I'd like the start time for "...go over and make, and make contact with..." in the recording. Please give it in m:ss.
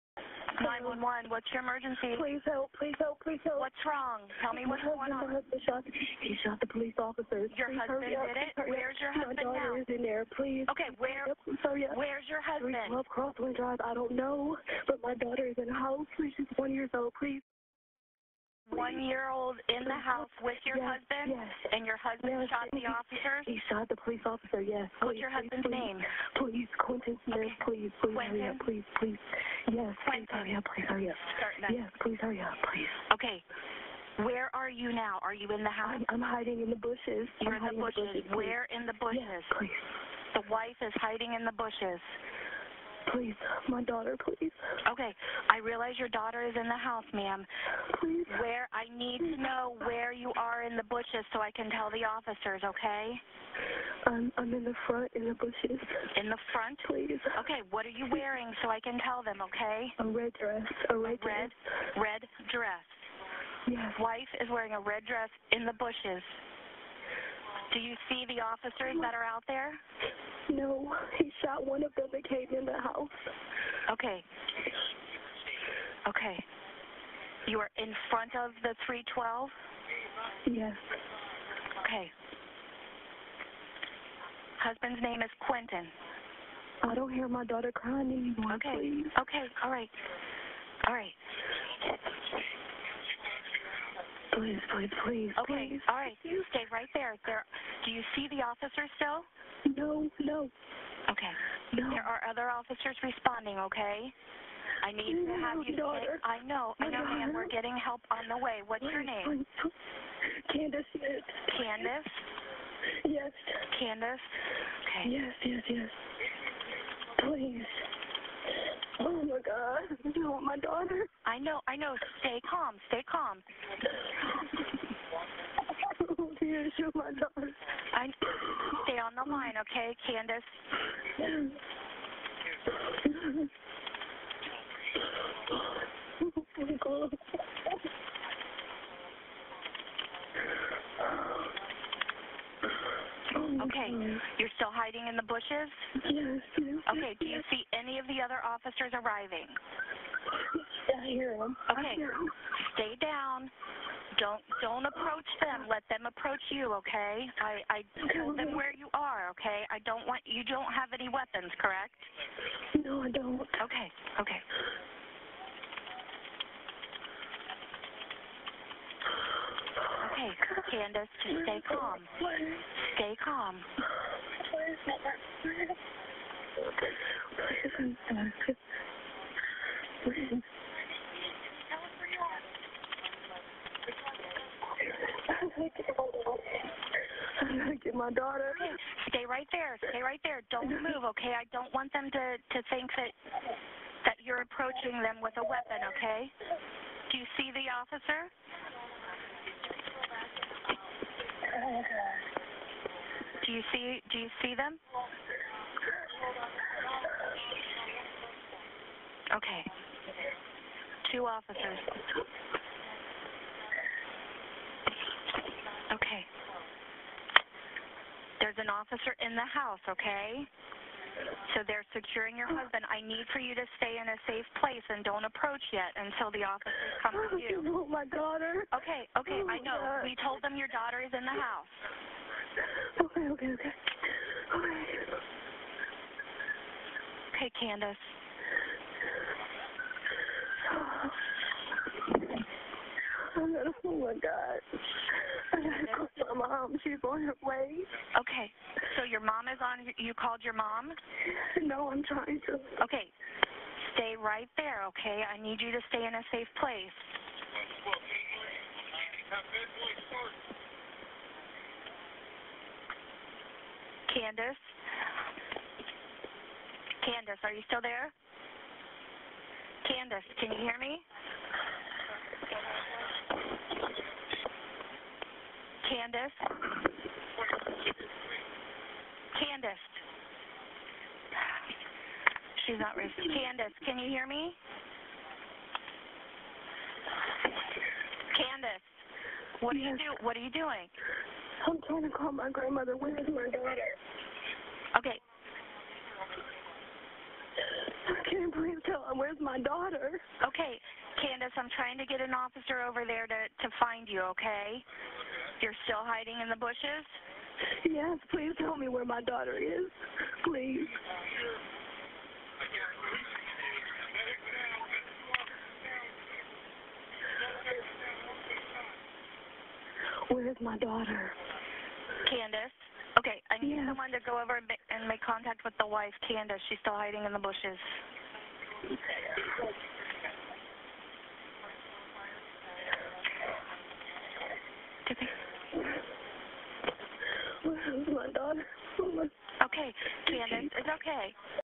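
5:24.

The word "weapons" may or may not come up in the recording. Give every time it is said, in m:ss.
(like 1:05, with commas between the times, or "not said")
2:41, 3:15.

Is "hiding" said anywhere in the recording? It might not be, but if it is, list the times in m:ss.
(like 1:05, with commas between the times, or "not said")
0:36, 0:41, 2:24, 5:06, 5:26.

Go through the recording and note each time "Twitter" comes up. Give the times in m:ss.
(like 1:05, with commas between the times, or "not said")
not said.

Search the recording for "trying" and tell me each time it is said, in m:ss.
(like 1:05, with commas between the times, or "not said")
4:12, 4:51, 5:01.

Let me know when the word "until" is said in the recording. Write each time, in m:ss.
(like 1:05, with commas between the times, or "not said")
3:45.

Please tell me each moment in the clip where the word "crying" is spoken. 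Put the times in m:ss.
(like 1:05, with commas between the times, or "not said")
1:27.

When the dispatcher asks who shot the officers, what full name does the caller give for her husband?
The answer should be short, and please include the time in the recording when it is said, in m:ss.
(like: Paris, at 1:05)
Quentin Smith, at 0:26.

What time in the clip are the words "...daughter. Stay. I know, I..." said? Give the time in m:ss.
1:45.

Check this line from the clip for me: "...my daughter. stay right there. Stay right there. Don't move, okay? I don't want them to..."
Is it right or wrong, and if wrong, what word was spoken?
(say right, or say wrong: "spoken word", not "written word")
right.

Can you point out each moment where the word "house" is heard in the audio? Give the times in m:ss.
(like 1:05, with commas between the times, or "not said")
0:15, 0:19, 0:35, 0:46, 1:12, 3:39, 3:51.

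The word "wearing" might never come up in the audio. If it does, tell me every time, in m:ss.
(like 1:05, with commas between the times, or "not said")
0:58, 1:04.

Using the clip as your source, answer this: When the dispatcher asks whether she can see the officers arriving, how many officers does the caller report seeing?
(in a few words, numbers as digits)
2.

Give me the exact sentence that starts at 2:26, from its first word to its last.
Yes, Okay, do you see any of the other officers arriving?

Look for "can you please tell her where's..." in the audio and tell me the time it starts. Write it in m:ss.
4:58.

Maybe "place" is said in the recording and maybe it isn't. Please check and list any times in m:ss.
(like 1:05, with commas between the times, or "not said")
3:44, 4:16.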